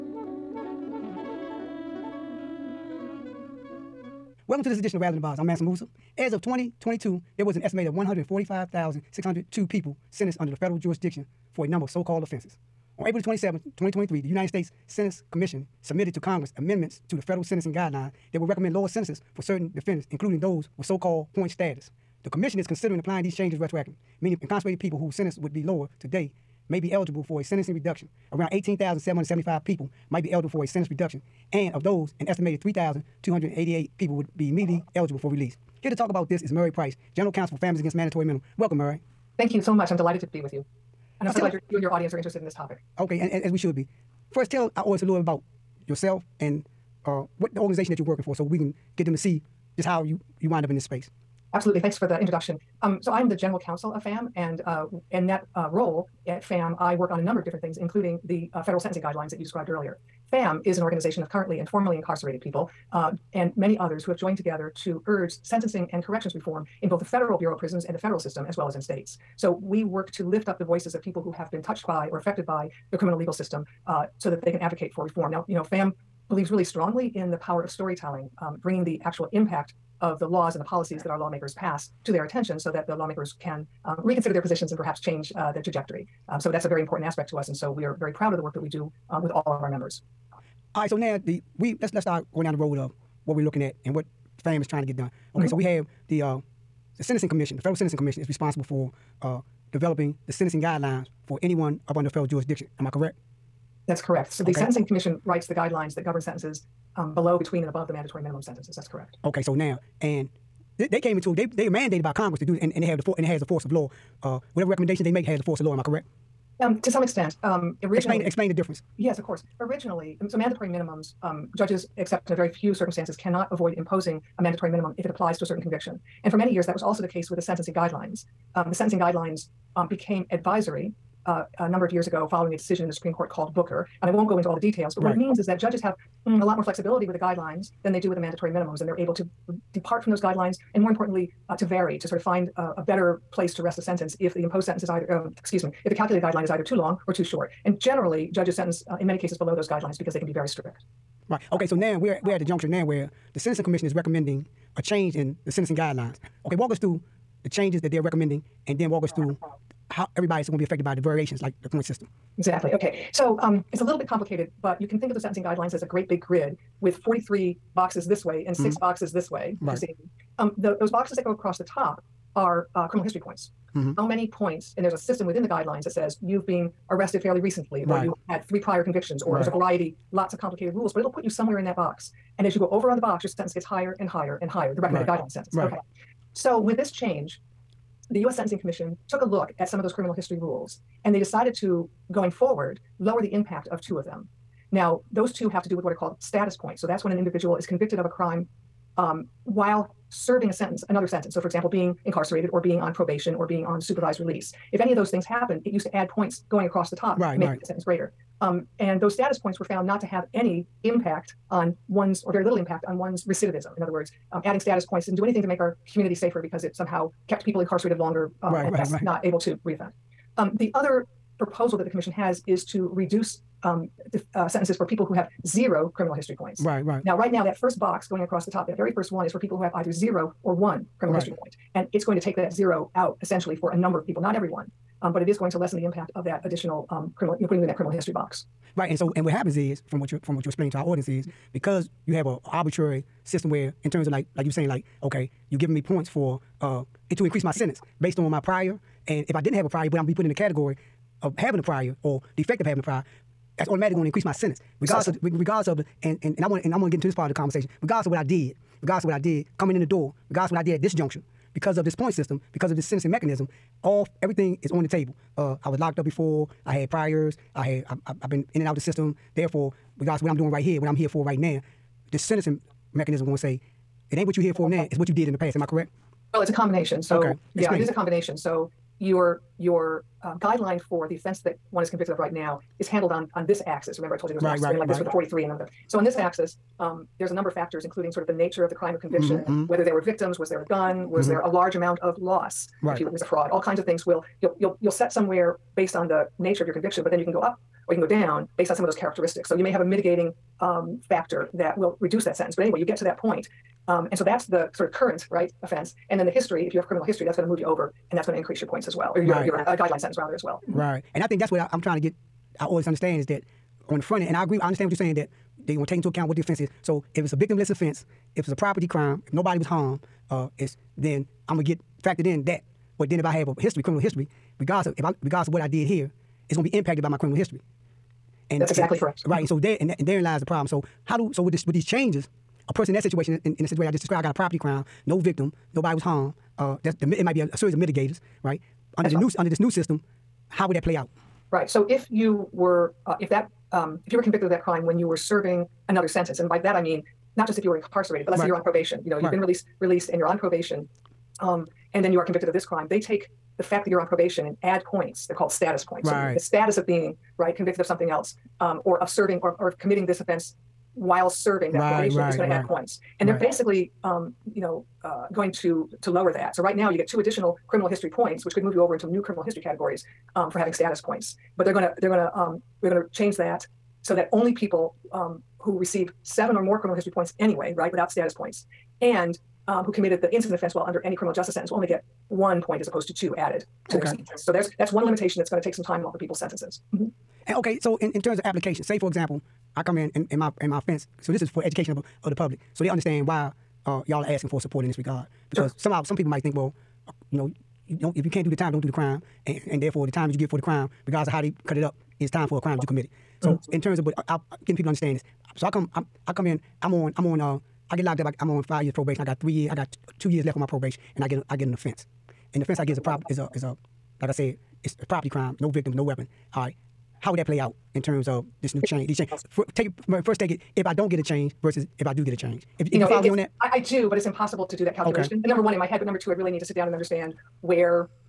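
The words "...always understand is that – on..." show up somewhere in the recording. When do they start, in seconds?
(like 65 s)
312 s.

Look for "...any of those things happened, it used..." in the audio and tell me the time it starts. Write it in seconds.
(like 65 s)
204 s.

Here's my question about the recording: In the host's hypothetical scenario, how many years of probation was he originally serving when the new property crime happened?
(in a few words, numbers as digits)
5 years.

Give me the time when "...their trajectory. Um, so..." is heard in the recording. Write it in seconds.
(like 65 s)
85 s.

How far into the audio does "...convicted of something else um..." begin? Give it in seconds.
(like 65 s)
357 s.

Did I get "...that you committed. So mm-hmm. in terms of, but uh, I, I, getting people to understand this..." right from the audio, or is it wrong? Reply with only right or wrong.
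right.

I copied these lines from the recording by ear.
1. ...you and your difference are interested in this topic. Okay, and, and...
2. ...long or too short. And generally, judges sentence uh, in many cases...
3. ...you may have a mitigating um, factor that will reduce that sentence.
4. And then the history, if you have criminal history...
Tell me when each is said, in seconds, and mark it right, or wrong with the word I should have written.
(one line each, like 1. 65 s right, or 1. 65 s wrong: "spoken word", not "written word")
1. 41 s wrong: "audience", not "difference"
2. 146 s right
3. 299 s right
4. 306 s right.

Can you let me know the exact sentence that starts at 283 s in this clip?
Remember, I told you there was an right, axis right, like right.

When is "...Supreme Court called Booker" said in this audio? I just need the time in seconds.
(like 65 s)
132 s.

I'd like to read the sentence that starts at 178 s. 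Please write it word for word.
or you had three prior convictions, or right.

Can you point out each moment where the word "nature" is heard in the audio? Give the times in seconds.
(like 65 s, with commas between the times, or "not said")
288 s, 296 s.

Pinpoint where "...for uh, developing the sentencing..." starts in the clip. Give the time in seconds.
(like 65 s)
98 s.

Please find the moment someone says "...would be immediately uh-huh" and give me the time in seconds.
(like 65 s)
34 s.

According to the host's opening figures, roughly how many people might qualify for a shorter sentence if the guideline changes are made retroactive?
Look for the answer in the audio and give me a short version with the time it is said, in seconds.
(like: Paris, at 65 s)
18,775, at 28 s.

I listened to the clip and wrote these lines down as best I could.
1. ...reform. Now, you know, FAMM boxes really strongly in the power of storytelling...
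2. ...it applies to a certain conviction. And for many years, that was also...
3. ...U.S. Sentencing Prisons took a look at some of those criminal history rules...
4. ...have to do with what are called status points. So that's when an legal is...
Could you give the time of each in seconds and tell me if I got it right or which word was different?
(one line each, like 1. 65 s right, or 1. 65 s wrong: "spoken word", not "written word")
1. 75 s wrong: "believes", not "boxes"
2. 125 s right
3. 188 s wrong: "Commission", not "Prisons"
4. 195 s wrong: "individual", not "legal".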